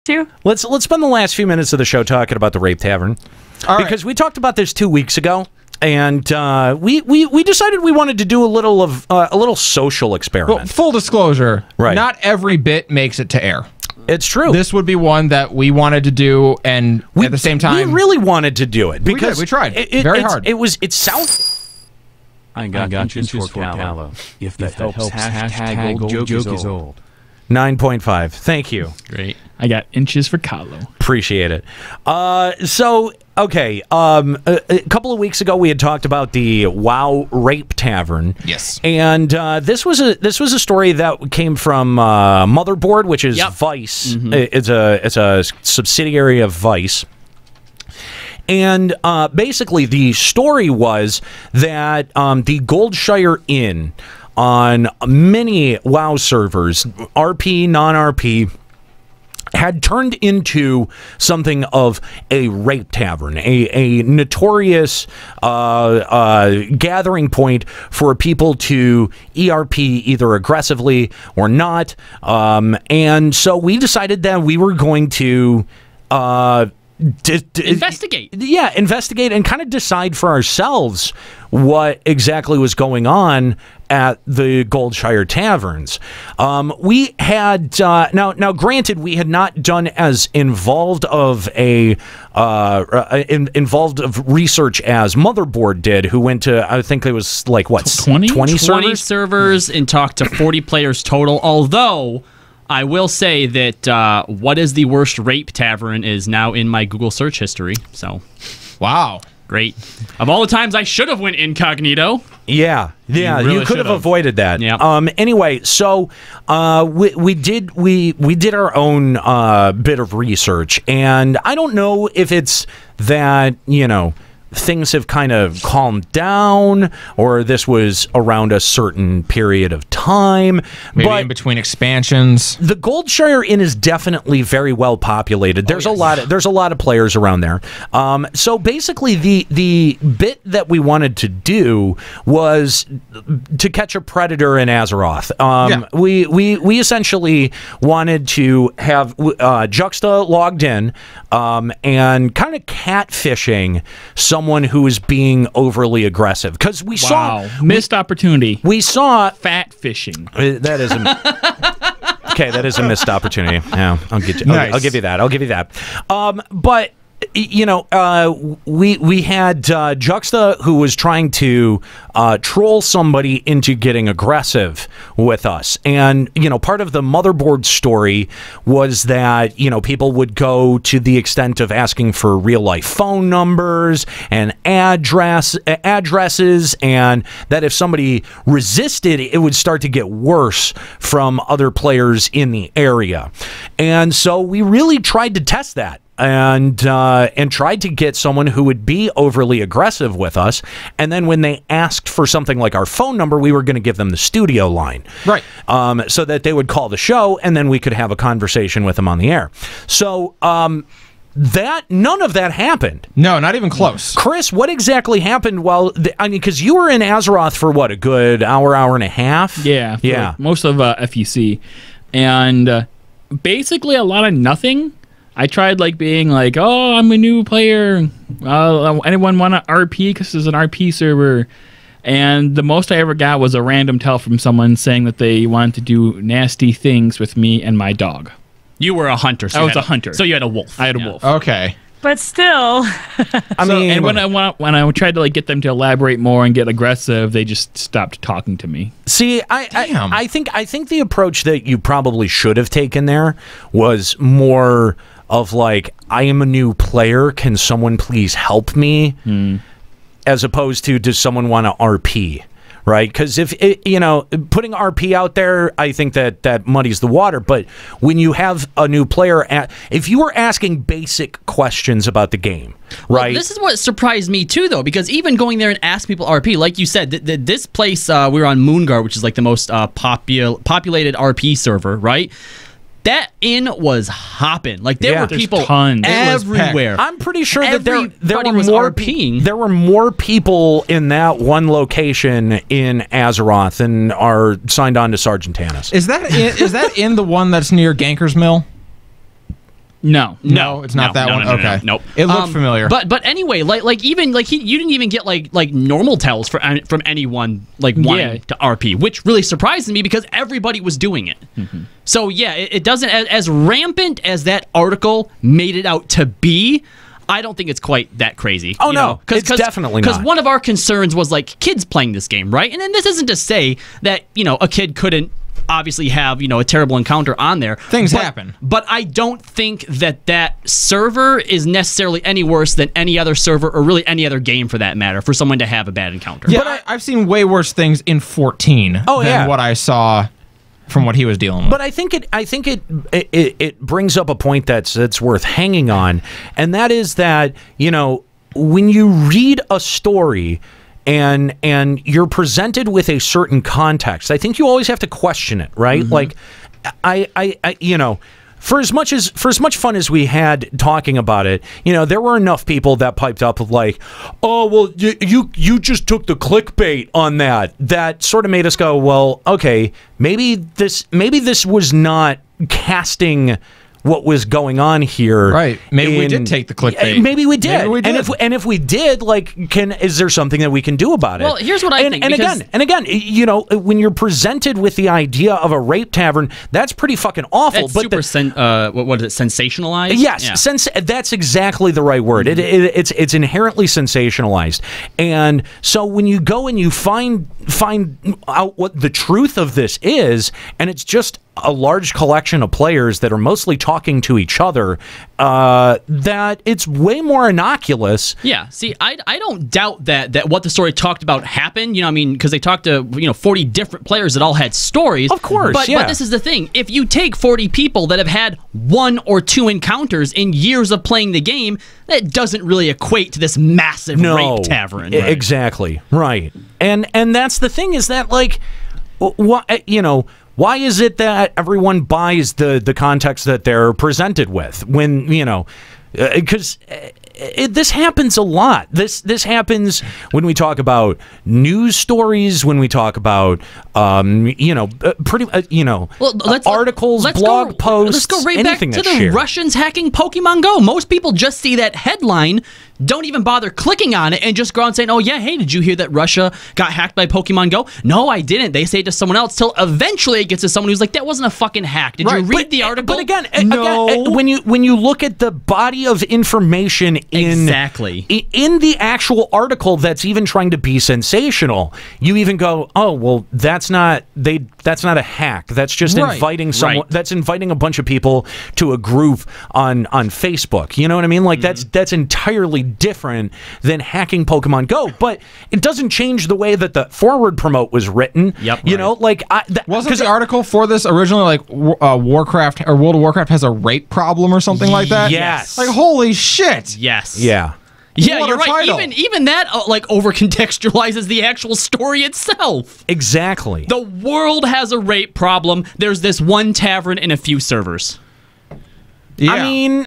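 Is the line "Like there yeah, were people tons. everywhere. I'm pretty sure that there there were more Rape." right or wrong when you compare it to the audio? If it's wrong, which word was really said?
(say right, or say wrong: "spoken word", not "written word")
wrong: "RPing", not "Rape".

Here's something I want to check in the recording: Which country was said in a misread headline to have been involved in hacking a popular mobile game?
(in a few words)
Russia.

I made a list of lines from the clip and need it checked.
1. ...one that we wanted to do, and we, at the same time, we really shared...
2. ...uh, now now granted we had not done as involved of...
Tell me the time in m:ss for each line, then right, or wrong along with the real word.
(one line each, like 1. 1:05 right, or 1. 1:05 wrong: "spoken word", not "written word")
1. 0:14 wrong: "wanted", not "shared"
2. 1:27 right.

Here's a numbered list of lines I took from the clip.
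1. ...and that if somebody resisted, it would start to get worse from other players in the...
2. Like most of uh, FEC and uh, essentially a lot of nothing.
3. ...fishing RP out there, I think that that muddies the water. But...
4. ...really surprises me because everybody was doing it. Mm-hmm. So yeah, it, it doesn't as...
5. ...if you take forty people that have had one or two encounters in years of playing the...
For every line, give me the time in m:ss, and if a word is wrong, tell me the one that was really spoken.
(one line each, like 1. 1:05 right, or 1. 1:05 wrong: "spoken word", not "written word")
1. 3:06 right
2. 3:40 wrong: "basically", not "essentially"
3. 4:24 wrong: "putting", not "fishing"
4. 5:09 right
5. 6:56 right.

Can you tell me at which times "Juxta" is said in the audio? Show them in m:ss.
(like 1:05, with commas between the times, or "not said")
2:29, 2:49.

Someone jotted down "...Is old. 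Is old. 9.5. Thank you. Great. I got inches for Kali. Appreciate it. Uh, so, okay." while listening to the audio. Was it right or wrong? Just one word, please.
right.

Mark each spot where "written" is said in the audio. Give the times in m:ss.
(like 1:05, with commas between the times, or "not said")
8:08.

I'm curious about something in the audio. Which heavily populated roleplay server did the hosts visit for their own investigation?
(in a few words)
Moon Guard.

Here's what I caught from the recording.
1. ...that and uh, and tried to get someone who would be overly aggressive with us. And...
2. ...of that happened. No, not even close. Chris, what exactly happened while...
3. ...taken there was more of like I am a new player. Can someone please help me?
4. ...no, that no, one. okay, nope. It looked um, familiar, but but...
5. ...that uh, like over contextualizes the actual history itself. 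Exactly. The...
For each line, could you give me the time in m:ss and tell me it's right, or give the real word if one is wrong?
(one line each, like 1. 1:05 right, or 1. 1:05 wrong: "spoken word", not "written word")
1. 3:15 right
2. 3:32 right
3. 4:12 right
4. 5:01 right
5. 8:19 wrong: "story", not "history".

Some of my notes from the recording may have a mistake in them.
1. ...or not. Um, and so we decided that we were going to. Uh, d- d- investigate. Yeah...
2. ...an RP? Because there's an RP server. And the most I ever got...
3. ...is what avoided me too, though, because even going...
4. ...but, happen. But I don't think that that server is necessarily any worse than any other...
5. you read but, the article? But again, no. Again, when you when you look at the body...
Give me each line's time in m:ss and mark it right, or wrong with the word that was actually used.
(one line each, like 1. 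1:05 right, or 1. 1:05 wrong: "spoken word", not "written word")
1. 1:11 right
2. 3:49 right
3. 4:33 wrong: "surprised", not "avoided"
4. 5:28 right
5. 7:42 right.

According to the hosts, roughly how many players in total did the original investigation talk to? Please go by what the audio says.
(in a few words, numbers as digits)
40.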